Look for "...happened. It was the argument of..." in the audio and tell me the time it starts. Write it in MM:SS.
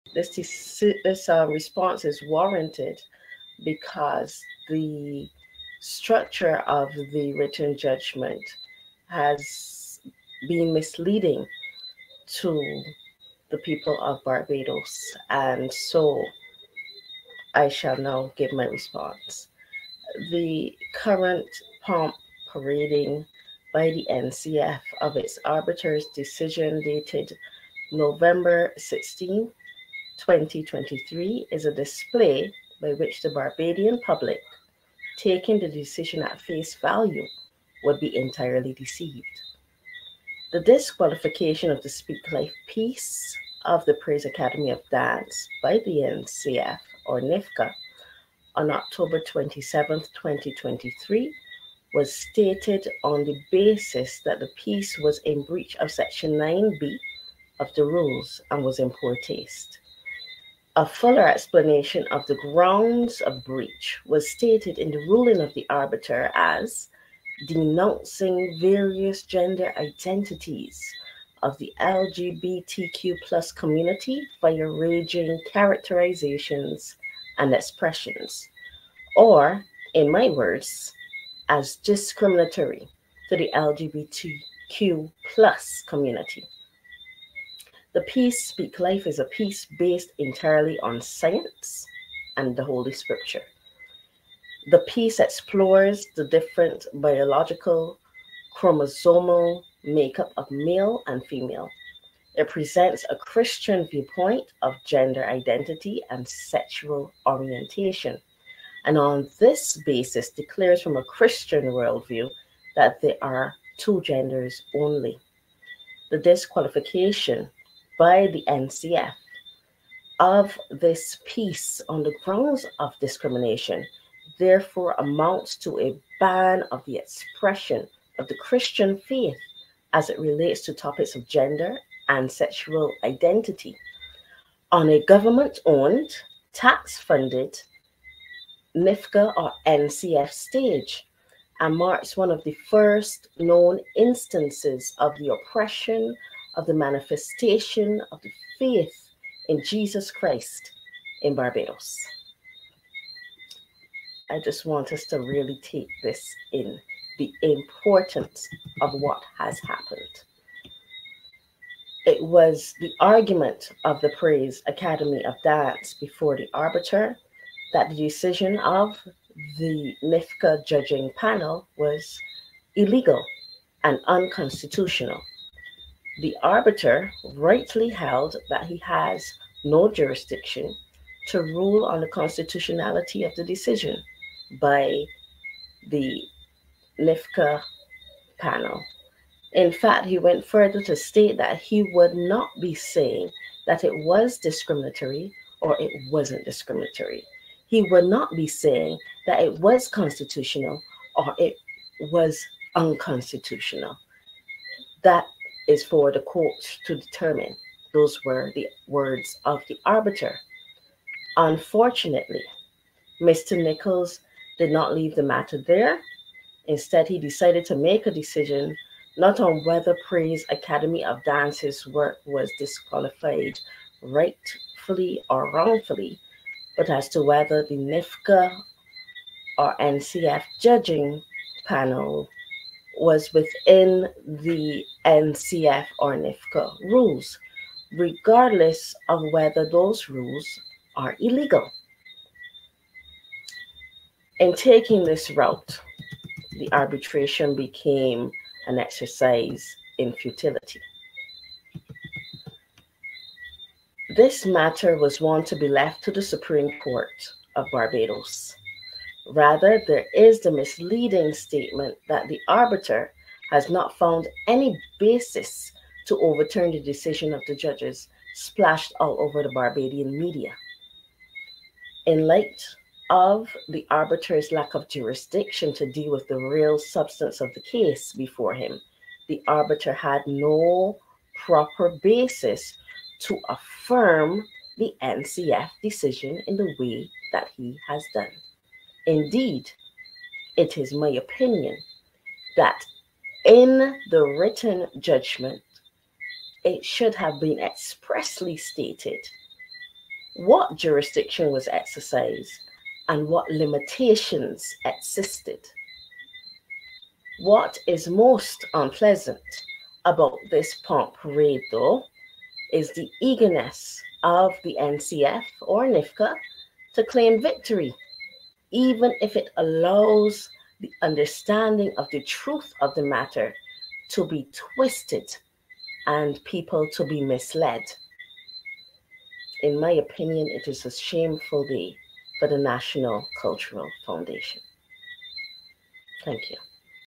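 02:39.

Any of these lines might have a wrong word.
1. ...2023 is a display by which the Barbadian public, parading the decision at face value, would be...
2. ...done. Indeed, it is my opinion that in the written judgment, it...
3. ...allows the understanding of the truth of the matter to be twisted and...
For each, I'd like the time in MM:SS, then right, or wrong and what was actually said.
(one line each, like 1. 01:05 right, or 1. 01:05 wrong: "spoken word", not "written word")
1. 00:30 wrong: "taking", not "parading"
2. 04:48 right
3. 05:19 right.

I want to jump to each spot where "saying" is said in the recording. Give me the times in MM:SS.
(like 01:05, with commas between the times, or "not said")
03:12, 03:18.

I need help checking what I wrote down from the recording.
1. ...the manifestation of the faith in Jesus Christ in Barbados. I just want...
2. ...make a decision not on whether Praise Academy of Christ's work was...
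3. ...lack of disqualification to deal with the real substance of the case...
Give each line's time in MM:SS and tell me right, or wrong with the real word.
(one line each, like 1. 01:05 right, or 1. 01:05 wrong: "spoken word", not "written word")
1. 02:26 right
2. 03:37 wrong: "Dance", not "Christ"
3. 04:34 wrong: "jurisdiction", not "disqualification".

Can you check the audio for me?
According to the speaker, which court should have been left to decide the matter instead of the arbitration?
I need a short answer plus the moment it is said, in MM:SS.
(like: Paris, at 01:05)
Supreme Court of Barbados, at 04:16.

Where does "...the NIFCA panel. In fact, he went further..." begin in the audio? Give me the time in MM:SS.
03:05.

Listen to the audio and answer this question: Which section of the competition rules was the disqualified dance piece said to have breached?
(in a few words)
Section 9B.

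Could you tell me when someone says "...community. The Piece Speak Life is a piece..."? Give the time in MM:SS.
01:25.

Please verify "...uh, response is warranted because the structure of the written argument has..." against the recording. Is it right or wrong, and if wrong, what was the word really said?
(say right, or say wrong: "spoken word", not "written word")
wrong: "judgment", not "argument".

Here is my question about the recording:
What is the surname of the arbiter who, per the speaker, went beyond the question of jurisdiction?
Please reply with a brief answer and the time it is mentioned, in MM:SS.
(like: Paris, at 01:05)
Nichols, at 03:33.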